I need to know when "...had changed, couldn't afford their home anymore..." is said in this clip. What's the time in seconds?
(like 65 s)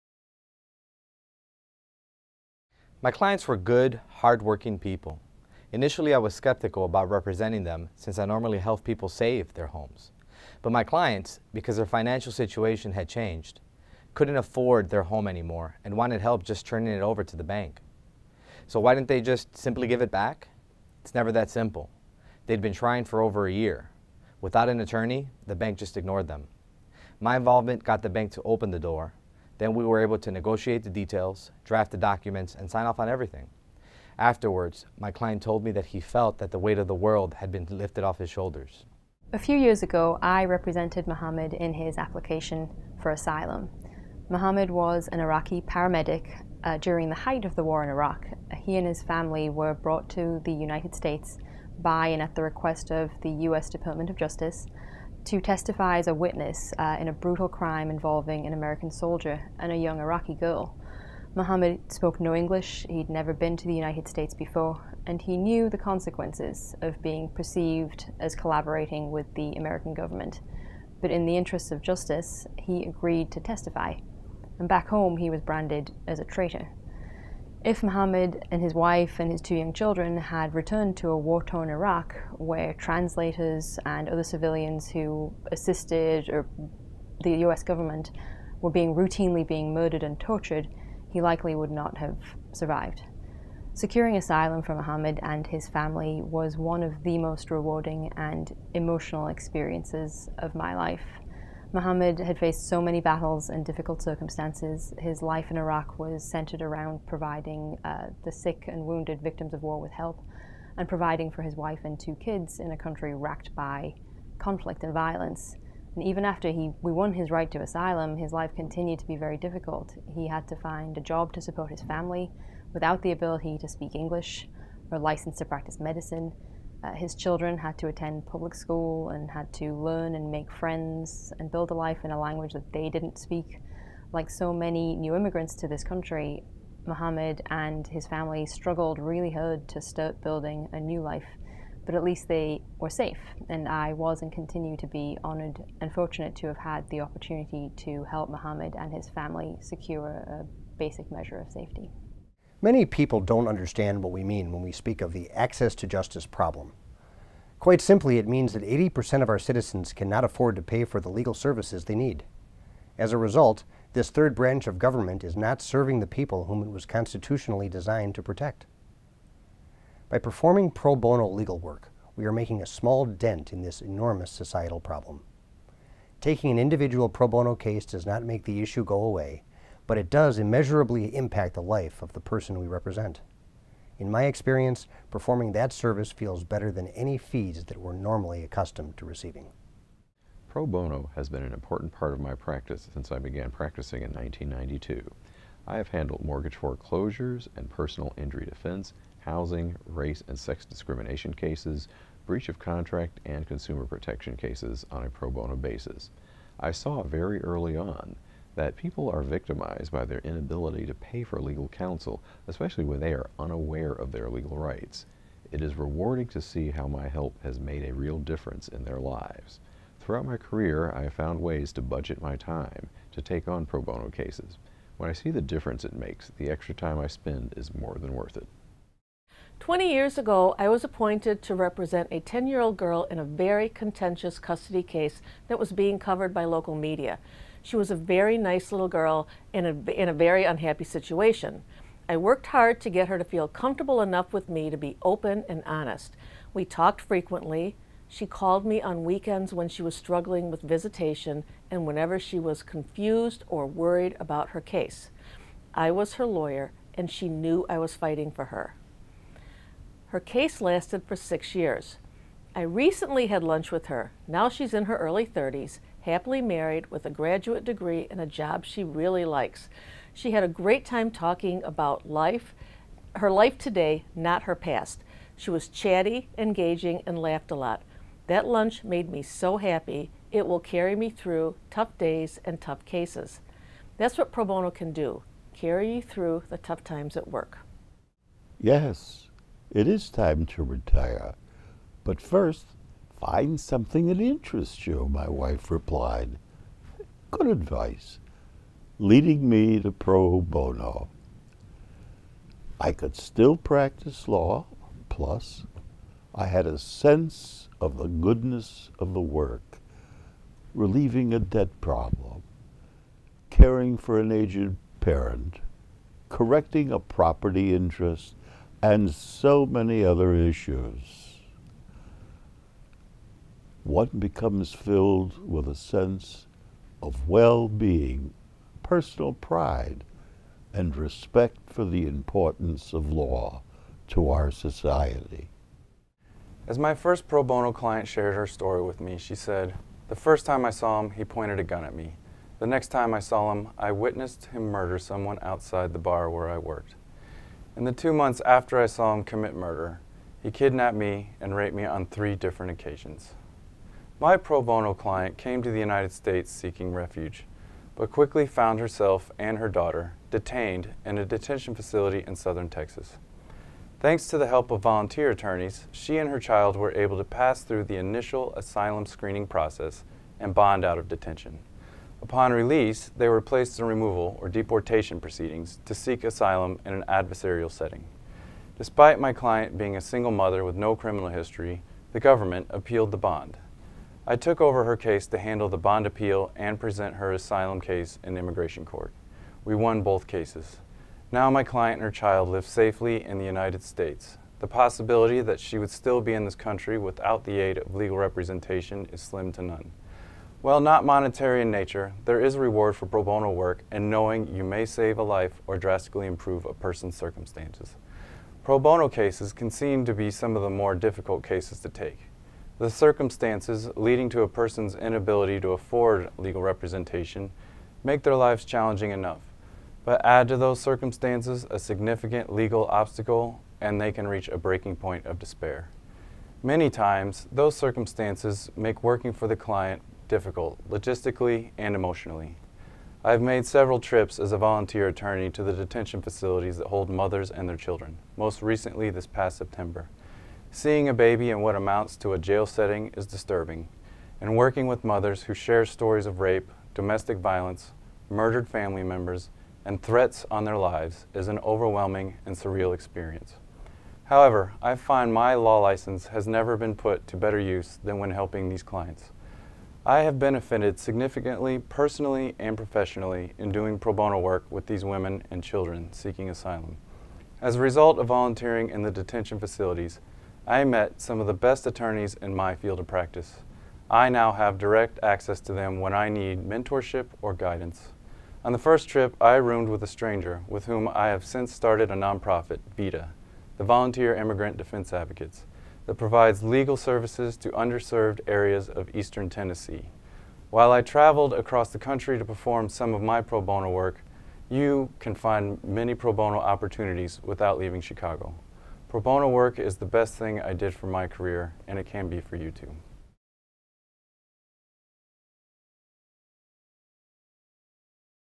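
12 s.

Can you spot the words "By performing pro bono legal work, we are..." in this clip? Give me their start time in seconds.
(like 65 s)
170 s.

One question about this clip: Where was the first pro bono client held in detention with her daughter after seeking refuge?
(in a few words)
southern Texas.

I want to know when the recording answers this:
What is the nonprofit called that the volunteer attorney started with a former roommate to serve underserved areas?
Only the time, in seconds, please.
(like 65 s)
482 s.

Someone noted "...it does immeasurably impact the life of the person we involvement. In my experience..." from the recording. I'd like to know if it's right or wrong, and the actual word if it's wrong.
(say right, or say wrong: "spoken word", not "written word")
wrong: "represent", not "involvement".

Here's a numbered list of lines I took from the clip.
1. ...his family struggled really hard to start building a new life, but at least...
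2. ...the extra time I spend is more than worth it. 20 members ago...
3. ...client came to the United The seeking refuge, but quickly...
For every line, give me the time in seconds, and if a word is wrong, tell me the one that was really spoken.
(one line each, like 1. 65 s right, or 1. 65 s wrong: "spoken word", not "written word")
1. 137 s right
2. 226 s wrong: "years", not "members"
3. 354 s wrong: "States", not "The".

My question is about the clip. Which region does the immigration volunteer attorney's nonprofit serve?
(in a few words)
eastern Tennessee.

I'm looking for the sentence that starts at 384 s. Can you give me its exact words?
I took over her case to handle the bond appeal and present her asylum case in immigration court.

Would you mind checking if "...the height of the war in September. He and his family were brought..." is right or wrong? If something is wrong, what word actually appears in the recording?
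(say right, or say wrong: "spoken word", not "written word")
wrong: "Iraq", not "September".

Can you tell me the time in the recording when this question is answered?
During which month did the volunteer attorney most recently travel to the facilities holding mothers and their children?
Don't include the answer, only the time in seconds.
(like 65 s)
439 s.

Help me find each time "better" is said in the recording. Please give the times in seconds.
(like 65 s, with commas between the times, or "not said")
186 s, 457 s.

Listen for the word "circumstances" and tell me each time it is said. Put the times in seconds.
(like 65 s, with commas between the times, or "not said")
104 s, 407 s, 412 s, 420 s, 427 s.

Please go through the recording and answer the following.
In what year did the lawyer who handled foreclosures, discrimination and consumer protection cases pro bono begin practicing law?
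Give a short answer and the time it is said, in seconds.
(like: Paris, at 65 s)
1992, at 194 s.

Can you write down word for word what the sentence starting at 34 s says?
Afterwards, my client told me that he felt that the weight of the world had been lifted off his shoulders.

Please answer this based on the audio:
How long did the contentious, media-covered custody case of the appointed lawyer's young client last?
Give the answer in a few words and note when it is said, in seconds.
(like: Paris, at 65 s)
6 years, at 261 s.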